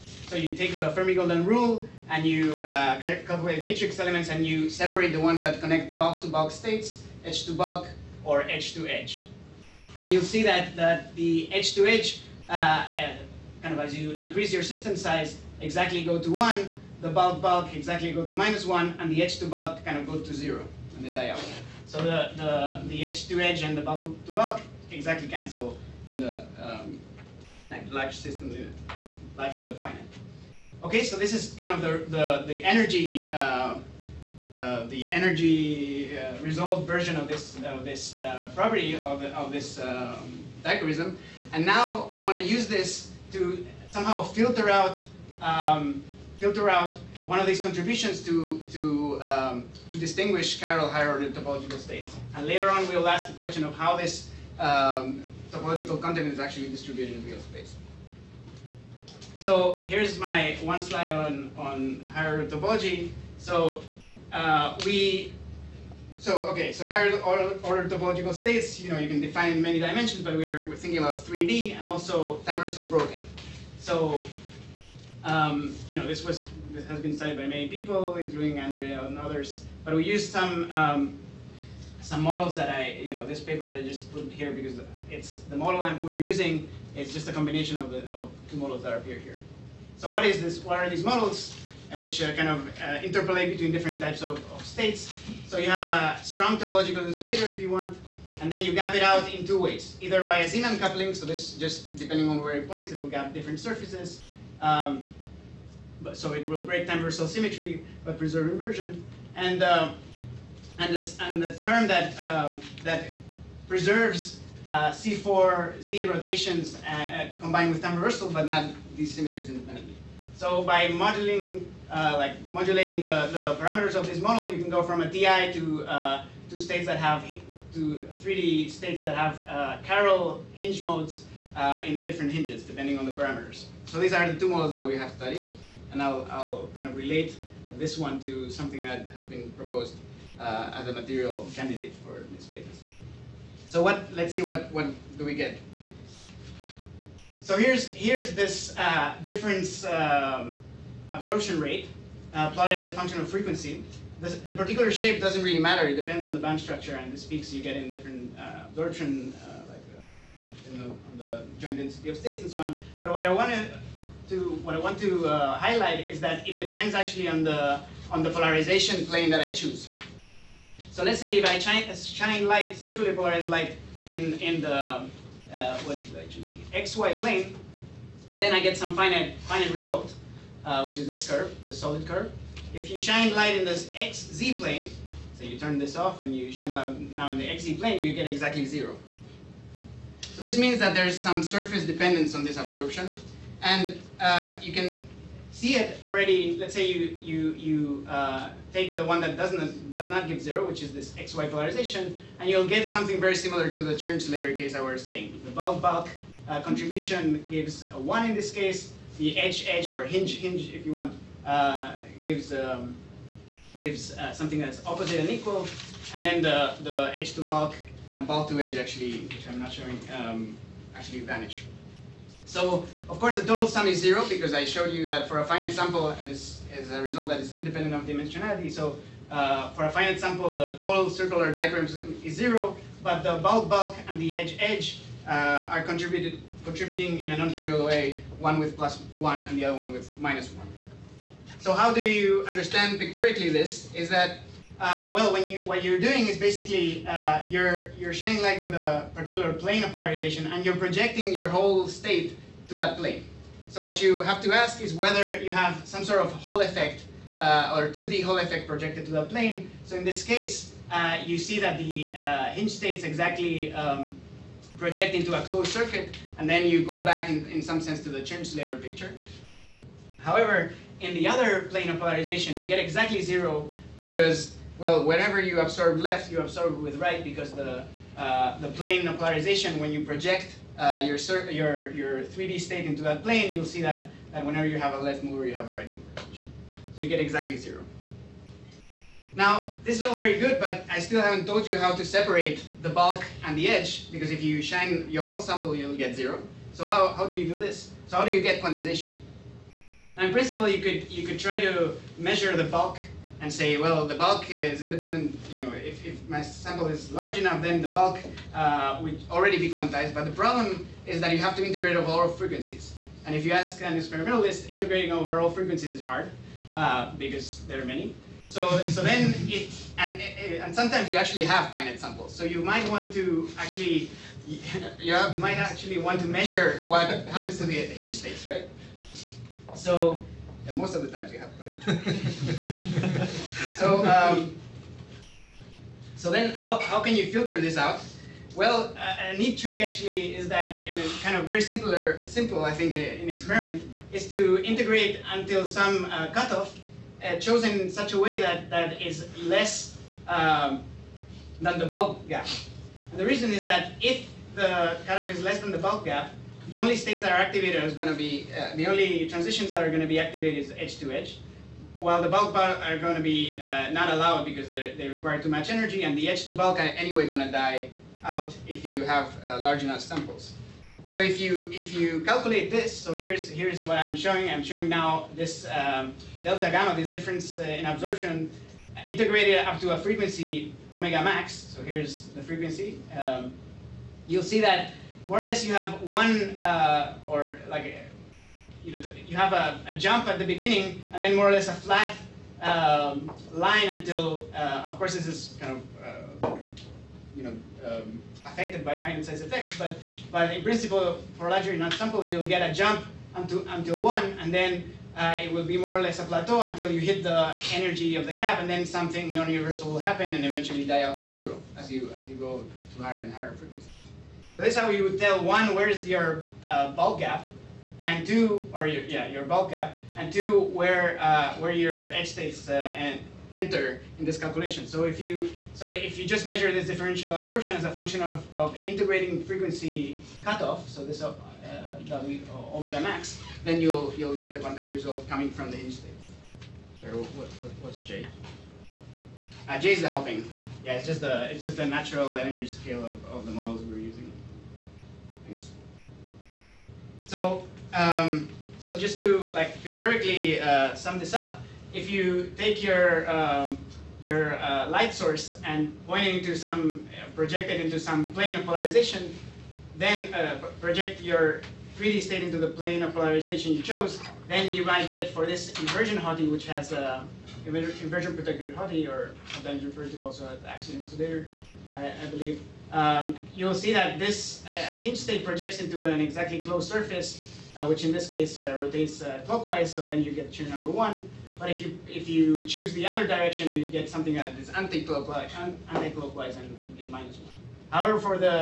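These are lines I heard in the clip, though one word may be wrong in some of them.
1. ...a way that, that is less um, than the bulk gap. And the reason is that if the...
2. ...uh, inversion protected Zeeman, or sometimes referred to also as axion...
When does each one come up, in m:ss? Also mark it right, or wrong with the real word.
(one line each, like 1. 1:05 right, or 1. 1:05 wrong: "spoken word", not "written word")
1. 5:48 right
2. 7:47 wrong: "HOTI", not "Zeeman".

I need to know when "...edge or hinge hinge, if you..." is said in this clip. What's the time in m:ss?
3:29.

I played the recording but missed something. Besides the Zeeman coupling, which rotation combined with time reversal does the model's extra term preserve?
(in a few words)
C4Z.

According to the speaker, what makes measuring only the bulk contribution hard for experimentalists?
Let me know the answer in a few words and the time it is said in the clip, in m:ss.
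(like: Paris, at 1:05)
Integrating over all frequencies, at 5:14.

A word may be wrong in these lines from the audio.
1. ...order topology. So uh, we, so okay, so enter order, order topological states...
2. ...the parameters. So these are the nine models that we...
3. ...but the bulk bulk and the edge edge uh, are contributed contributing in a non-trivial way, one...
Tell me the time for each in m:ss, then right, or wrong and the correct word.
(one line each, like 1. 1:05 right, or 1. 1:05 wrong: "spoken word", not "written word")
1. 1:02 wrong: "higher", not "enter"
2. 2:13 wrong: "two", not "nine"
3. 3:53 right.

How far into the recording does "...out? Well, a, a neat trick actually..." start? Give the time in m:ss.
5:37.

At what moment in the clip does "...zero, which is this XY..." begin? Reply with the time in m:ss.
3:20.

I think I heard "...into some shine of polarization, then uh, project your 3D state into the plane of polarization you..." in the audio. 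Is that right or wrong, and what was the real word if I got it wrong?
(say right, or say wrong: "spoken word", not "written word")
wrong: "plane", not "shine".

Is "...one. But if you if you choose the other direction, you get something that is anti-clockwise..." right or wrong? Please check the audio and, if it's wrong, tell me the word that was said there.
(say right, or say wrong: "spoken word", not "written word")
right.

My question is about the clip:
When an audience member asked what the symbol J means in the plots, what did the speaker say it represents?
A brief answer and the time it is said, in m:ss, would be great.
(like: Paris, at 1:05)
The hopping, at 7:20.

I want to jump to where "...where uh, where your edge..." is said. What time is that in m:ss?
7:00.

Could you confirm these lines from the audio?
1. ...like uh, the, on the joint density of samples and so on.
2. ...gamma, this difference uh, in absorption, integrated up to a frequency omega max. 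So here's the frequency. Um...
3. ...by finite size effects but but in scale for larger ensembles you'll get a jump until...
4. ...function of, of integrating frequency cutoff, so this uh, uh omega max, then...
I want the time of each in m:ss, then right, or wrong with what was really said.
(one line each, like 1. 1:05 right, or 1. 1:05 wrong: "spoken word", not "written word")
1. 2:39 wrong: "states", not "samples"
2. 6:16 right
3. 6:38 wrong: "principle", not "scale"
4. 7:07 right.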